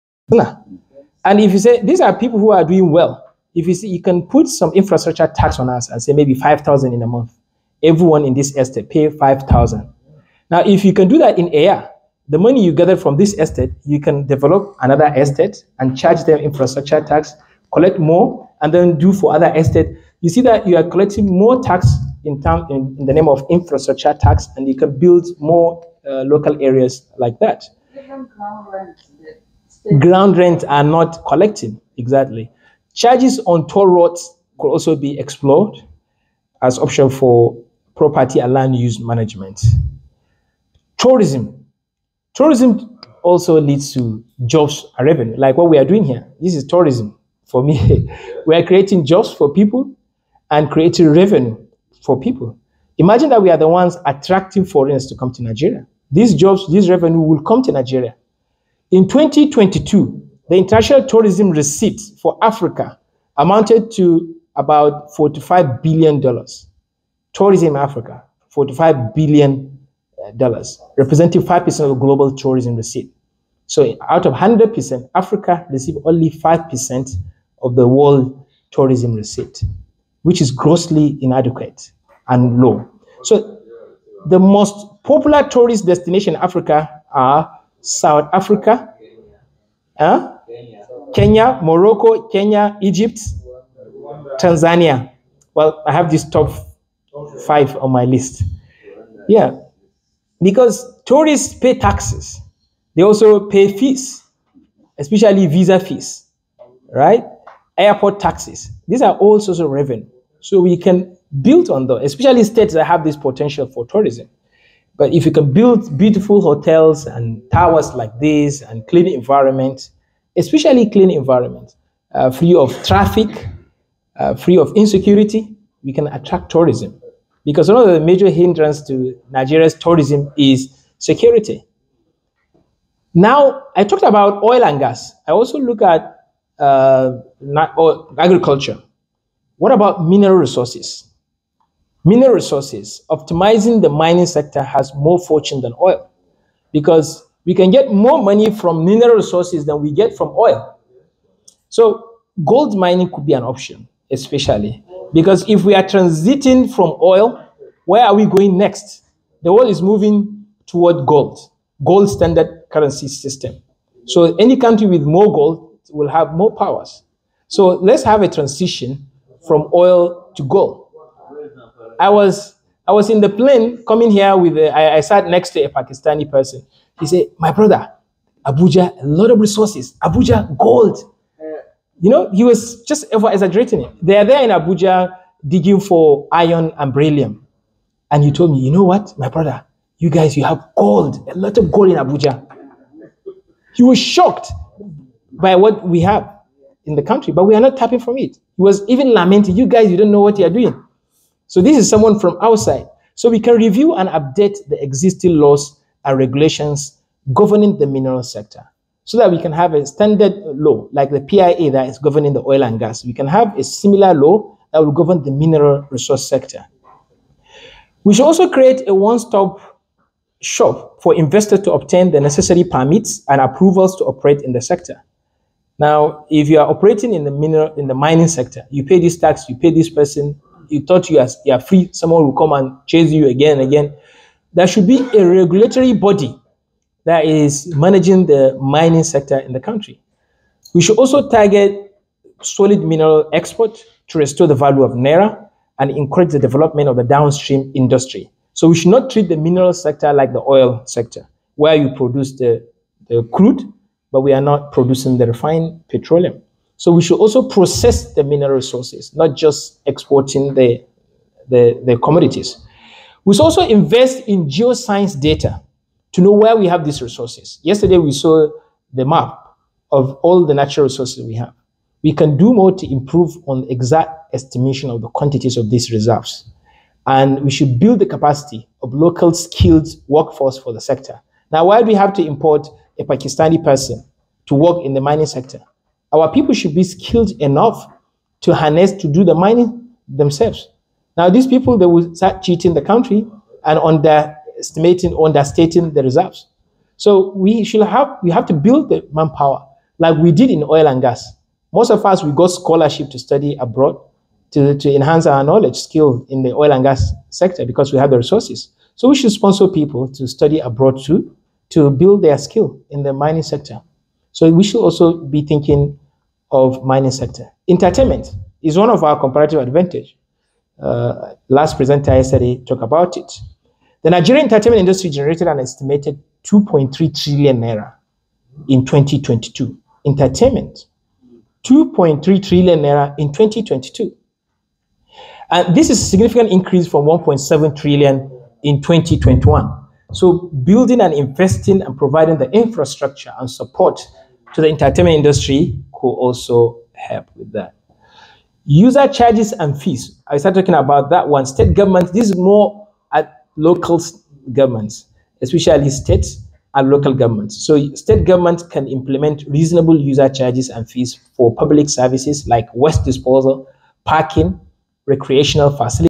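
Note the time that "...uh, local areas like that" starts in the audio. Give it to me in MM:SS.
00:26.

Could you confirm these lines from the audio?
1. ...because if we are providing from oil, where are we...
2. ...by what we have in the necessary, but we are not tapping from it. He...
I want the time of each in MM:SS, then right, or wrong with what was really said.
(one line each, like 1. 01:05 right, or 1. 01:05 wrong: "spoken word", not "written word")
1. 02:35 wrong: "transiting", not "providing"
2. 03:15 wrong: "country", not "necessary".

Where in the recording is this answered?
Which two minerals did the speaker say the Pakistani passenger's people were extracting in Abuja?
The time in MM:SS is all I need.
03:06.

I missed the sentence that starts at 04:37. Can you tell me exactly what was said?
And we should build the capacity of local skilled workforce for the sector.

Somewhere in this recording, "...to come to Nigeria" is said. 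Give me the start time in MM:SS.
00:55.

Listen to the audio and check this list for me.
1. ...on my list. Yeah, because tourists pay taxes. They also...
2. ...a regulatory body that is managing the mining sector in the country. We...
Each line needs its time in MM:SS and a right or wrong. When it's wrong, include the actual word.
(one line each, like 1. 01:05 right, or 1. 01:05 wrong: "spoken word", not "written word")
1. 01:37 right
2. 03:55 right.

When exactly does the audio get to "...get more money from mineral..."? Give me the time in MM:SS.
02:27.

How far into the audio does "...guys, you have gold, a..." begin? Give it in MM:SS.
03:10.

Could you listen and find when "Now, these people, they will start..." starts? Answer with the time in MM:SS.
04:51.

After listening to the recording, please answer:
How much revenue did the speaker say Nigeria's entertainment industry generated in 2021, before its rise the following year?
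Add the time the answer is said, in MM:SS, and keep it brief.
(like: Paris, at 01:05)
1.7 trillion naira, at 05:37.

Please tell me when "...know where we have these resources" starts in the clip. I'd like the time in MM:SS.
04:26.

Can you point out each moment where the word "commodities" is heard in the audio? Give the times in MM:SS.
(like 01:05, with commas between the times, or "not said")
04:21.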